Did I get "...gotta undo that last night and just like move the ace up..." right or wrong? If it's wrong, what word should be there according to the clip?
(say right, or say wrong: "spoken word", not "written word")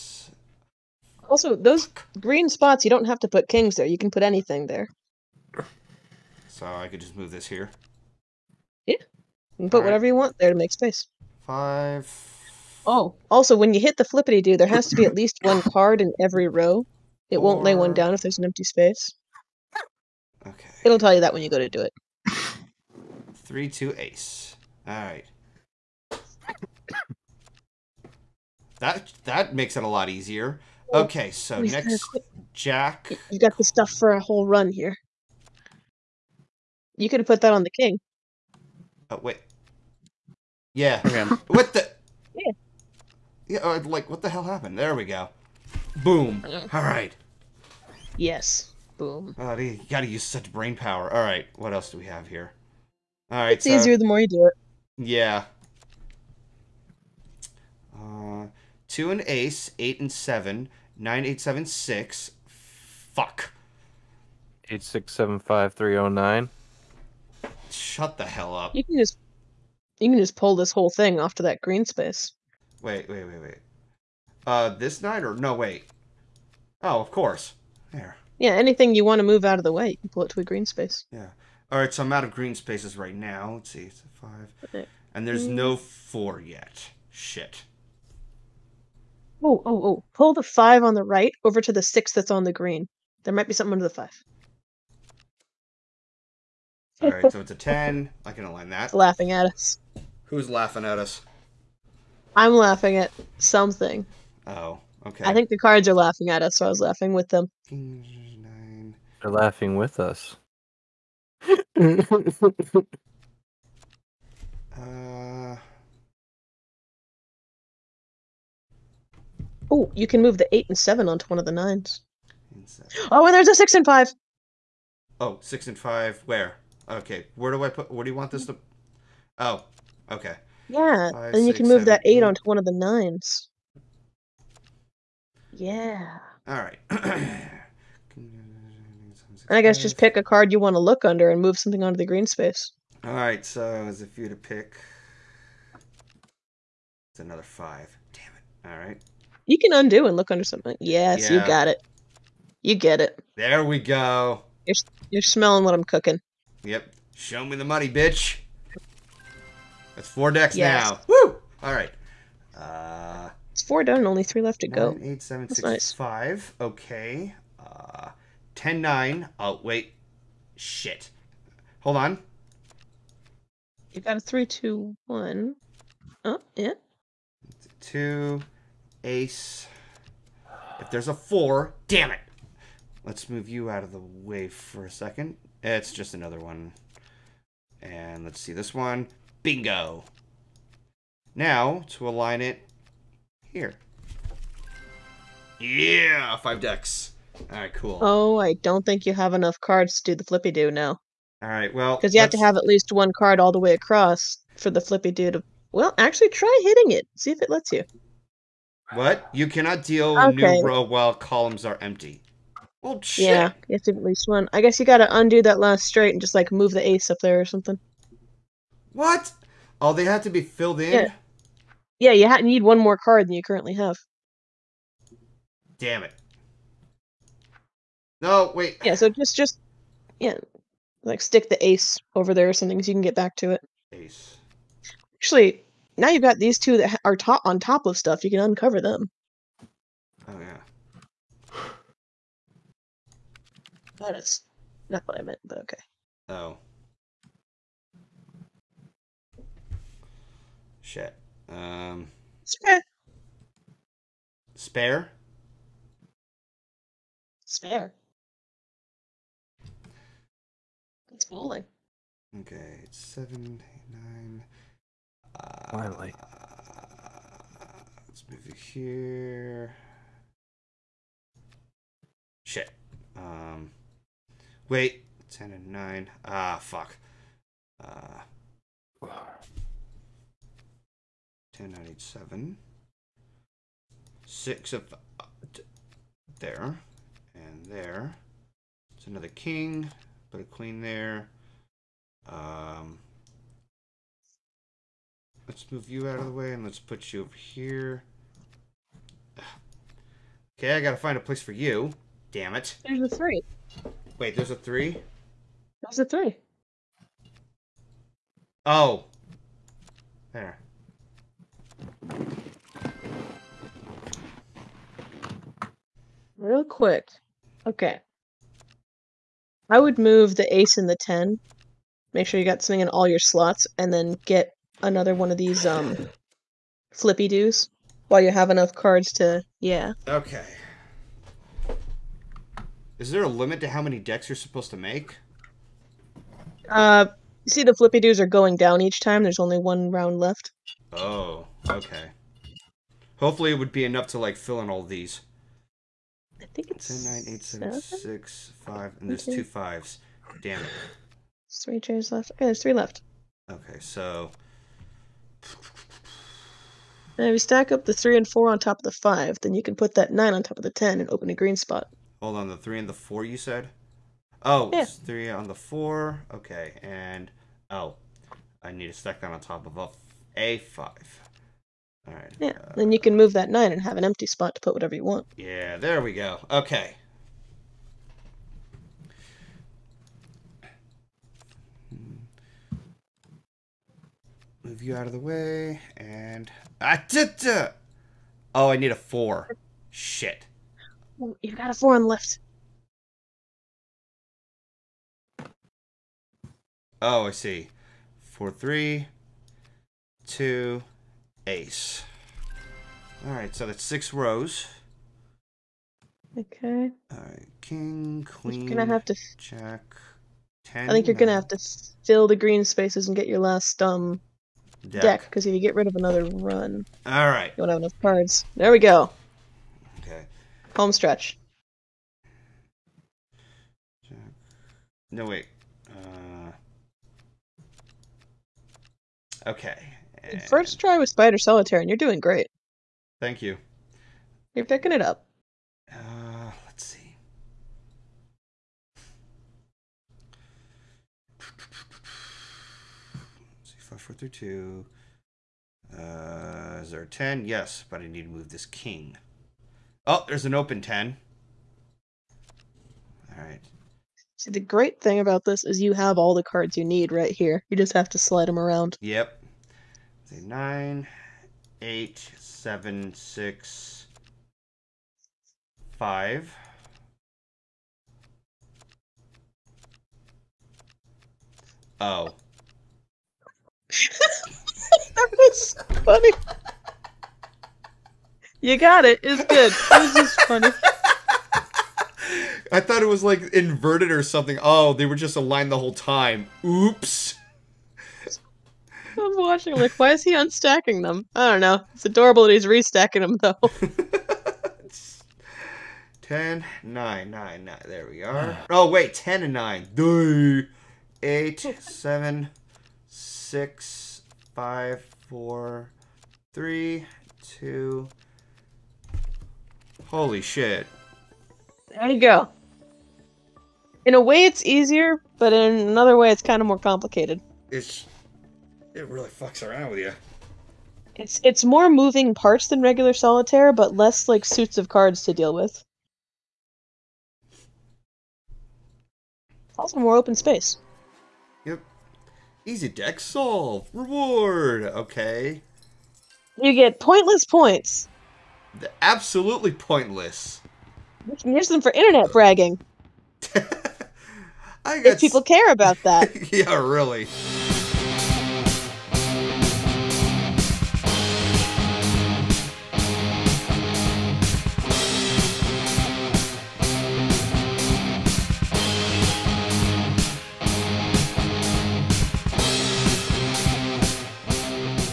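wrong: "straight", not "night".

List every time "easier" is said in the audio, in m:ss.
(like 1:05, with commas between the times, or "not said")
0:30, 0:53, 8:34.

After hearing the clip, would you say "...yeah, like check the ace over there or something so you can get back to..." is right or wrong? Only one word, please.
wrong.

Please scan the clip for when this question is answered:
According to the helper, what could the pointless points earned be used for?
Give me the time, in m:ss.
9:01.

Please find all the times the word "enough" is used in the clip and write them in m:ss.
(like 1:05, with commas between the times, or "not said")
3:19, 5:28, 5:43, 6:57.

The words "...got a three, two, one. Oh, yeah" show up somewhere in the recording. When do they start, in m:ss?
2:54.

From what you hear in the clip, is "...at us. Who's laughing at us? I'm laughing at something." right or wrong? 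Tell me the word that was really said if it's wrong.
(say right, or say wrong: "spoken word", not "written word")
right.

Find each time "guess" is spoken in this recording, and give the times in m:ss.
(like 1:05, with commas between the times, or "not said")
2:19, 3:34, 9:04.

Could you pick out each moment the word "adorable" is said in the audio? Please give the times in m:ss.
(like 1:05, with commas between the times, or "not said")
8:12.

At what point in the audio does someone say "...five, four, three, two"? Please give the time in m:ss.
7:23.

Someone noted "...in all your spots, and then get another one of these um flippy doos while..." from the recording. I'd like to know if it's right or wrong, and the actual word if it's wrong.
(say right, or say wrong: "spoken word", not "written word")
wrong: "slots", not "spots".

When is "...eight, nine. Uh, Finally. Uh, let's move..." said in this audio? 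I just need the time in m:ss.
4:23.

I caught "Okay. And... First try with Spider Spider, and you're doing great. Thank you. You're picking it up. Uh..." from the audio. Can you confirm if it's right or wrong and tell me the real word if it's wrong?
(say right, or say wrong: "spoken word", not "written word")
wrong: "Solitaire", not "Spider".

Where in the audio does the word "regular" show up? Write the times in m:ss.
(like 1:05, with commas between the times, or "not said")
8:42.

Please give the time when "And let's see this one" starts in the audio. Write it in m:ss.
3:07.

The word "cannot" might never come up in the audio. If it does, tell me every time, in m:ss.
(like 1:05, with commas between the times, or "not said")
3:29.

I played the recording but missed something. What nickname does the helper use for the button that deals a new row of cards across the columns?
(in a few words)
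flippity do.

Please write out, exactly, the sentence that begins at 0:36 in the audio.
You could have put that on the king.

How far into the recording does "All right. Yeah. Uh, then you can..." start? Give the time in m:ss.
6:12.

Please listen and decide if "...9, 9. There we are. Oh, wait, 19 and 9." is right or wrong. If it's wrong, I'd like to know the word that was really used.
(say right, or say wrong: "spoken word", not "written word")
wrong: "10", not "19".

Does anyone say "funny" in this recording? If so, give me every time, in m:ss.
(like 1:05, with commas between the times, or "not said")
7:56, 8:00.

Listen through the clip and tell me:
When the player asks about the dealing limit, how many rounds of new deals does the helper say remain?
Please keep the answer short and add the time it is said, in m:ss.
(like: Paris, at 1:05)
1, at 5:39.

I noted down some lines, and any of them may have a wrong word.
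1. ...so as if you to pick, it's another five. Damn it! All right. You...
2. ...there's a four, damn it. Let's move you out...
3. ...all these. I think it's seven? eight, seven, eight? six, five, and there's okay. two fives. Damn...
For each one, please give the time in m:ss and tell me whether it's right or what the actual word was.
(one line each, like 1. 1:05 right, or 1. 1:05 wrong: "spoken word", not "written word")
1. 2:23 right
2. 3:00 right
3. 5:44 wrong: "seven", not "eight".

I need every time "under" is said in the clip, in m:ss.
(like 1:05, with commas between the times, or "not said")
1:33, 2:21, 2:30.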